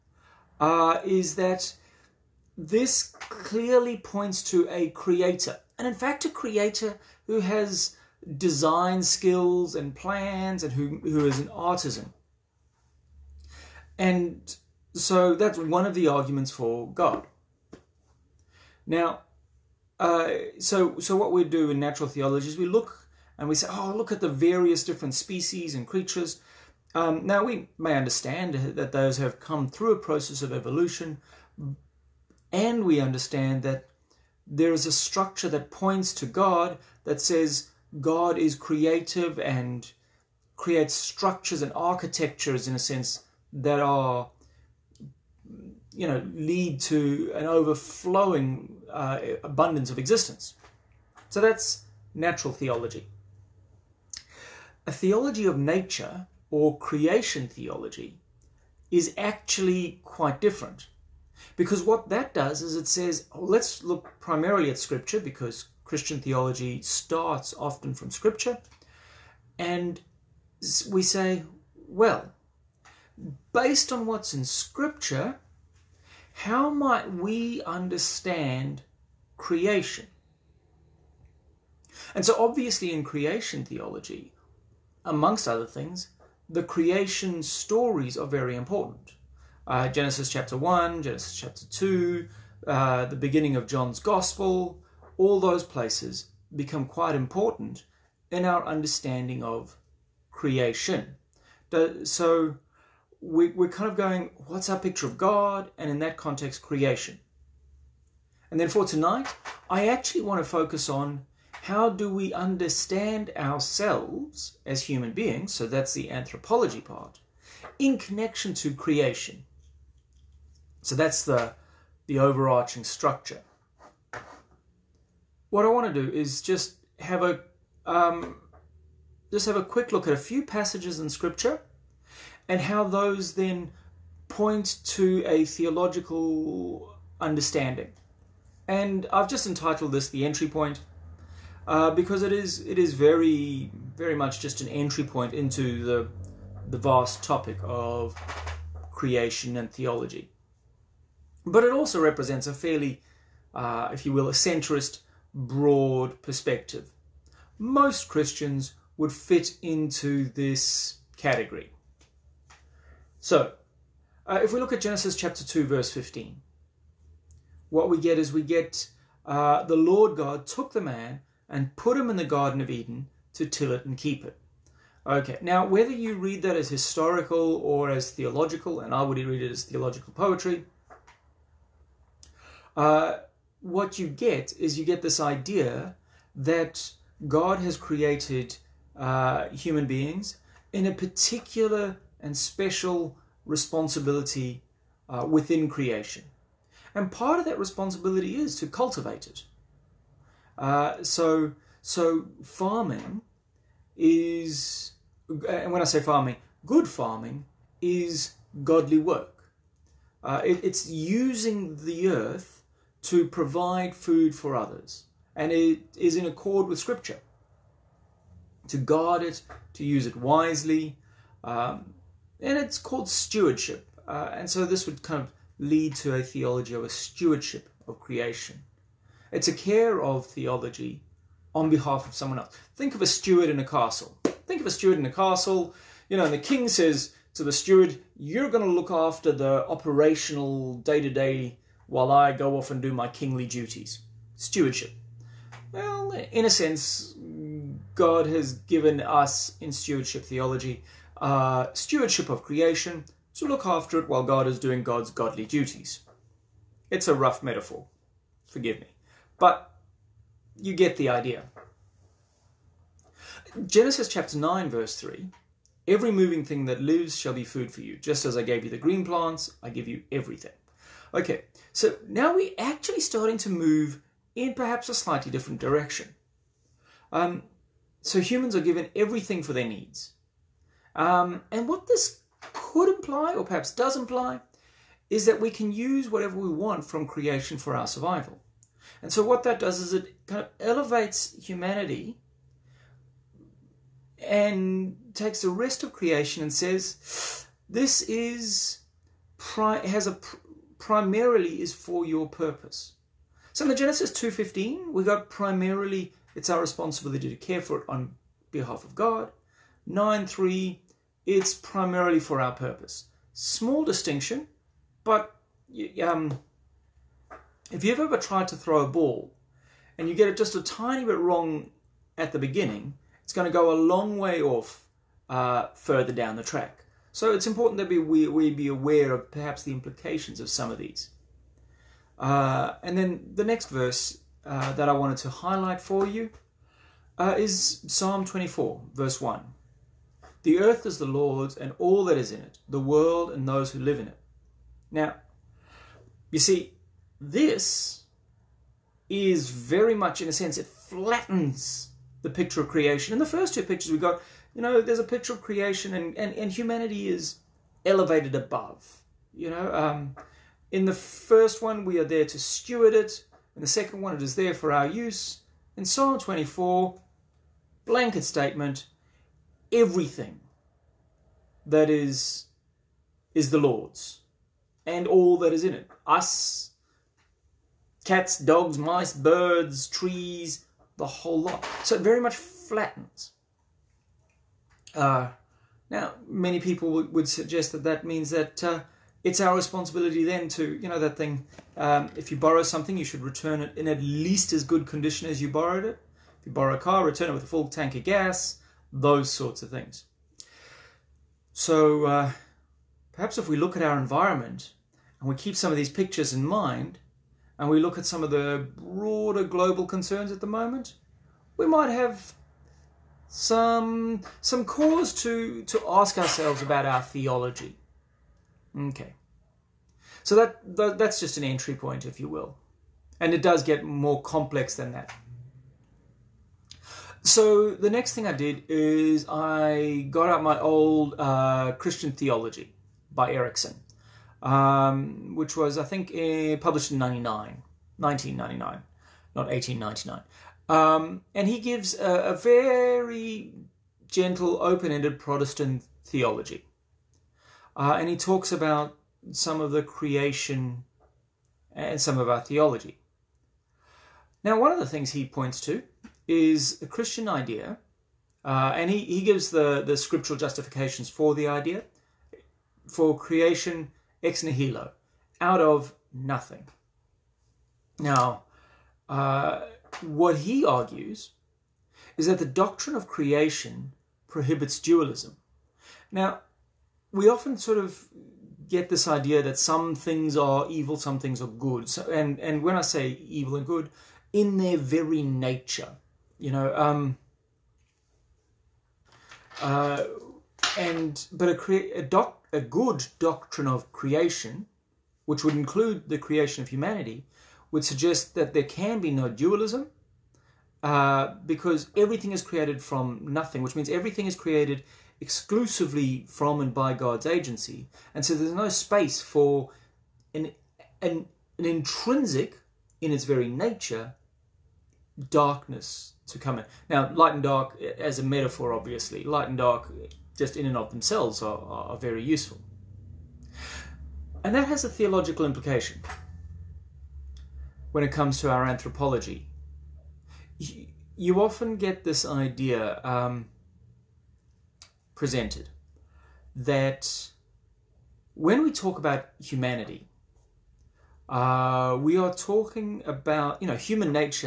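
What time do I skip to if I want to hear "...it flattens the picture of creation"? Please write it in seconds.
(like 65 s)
350 s.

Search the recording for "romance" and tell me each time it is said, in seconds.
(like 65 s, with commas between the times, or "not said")
not said.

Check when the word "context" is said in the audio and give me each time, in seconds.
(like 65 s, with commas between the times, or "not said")
106 s.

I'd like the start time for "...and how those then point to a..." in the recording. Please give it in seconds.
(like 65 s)
132 s.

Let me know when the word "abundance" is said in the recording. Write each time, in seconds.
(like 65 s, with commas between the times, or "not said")
49 s.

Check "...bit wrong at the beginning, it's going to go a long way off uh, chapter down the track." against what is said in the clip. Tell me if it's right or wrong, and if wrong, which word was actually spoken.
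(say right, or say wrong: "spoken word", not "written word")
wrong: "further", not "chapter".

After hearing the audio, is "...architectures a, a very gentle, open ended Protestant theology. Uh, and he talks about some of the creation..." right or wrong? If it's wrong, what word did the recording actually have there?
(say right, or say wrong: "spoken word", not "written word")
wrong: "gives", not "architectures".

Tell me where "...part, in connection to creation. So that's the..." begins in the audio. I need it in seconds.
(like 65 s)
116 s.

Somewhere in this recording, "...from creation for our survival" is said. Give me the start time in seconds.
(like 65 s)
286 s.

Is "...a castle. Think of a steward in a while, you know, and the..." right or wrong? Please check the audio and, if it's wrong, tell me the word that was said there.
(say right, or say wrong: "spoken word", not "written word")
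wrong: "castle", not "while".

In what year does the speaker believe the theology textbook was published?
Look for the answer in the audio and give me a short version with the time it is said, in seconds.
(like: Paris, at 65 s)
1999, at 437 s.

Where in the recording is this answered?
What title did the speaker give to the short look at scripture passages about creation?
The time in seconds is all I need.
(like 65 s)
140 s.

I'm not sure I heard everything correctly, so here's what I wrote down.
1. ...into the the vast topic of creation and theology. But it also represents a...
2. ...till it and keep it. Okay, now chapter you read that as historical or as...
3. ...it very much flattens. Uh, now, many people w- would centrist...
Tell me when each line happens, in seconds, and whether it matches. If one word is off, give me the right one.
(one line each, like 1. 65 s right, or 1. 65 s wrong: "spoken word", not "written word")
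1. 145 s right
2. 173 s wrong: "whether", not "chapter"
3. 381 s wrong: "suggest", not "centrist".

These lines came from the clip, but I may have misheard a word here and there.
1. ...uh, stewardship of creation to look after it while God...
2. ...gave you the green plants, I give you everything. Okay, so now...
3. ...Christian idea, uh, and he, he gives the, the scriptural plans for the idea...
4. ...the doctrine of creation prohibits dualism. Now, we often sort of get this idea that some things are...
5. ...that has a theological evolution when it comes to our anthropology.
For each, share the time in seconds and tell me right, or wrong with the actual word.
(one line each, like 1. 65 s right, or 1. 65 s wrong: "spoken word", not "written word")
1. 251 s right
2. 268 s right
3. 456 s wrong: "justifications", not "plans"
4. 472 s right
5. 524 s wrong: "implication", not "evolution".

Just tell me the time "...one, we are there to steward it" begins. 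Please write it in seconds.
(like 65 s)
361 s.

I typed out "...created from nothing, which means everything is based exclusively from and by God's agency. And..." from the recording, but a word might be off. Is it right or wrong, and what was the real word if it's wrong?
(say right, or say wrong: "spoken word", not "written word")
wrong: "created", not "based".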